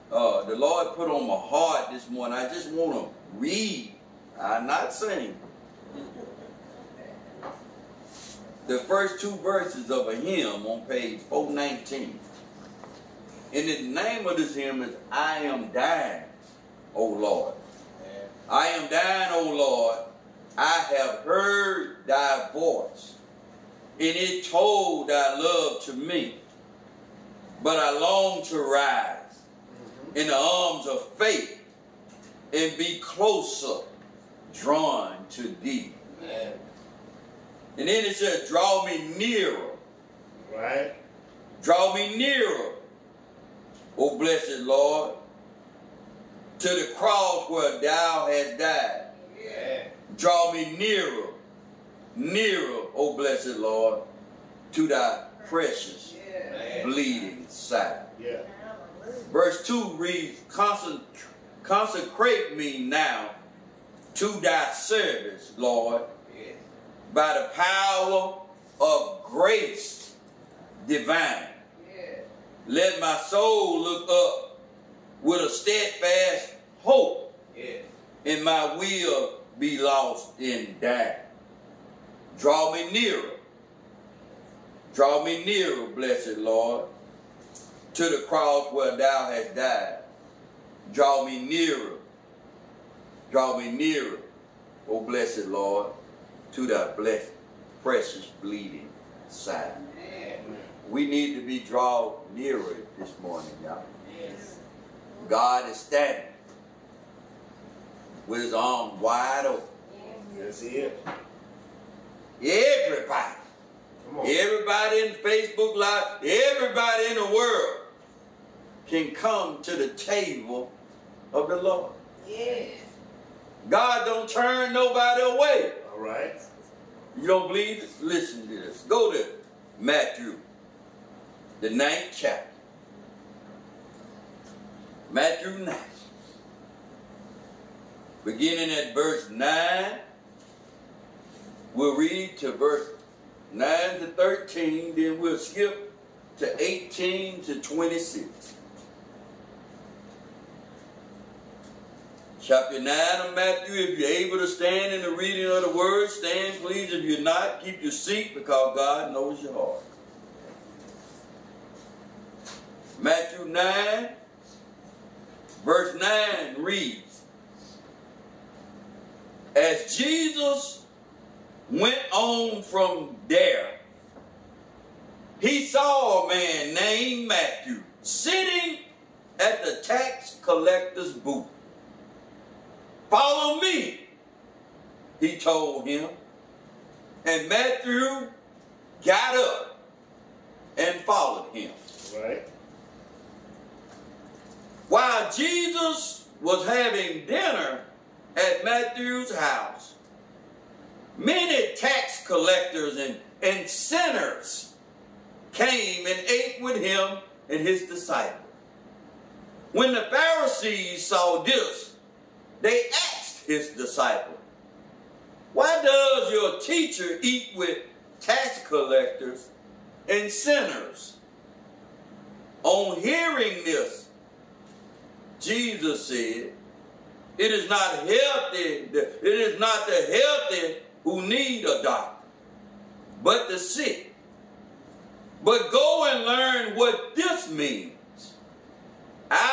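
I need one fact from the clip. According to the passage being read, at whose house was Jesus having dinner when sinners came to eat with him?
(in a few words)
Matthew's house.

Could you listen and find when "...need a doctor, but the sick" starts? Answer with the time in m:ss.
3:51.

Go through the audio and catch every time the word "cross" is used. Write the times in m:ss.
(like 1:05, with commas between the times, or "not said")
0:46, 1:28.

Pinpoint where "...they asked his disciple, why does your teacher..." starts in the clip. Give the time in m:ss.
3:32.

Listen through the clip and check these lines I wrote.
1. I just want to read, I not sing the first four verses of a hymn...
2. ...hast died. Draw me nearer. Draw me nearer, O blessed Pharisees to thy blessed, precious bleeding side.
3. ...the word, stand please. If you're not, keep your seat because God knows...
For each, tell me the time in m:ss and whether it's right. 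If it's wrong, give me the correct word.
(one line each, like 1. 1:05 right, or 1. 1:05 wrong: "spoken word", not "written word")
1. 0:02 wrong: "two", not "four"
2. 1:29 wrong: "Lord", not "Pharisees"
3. 2:35 right.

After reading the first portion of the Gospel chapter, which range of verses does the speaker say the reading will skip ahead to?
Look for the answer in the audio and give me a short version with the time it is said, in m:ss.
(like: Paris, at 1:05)
18 to 26, at 2:26.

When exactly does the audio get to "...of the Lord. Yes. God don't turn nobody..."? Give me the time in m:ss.
2:01.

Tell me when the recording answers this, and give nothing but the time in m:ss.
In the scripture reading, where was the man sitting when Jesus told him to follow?
2:59.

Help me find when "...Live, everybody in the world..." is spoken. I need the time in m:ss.
1:55.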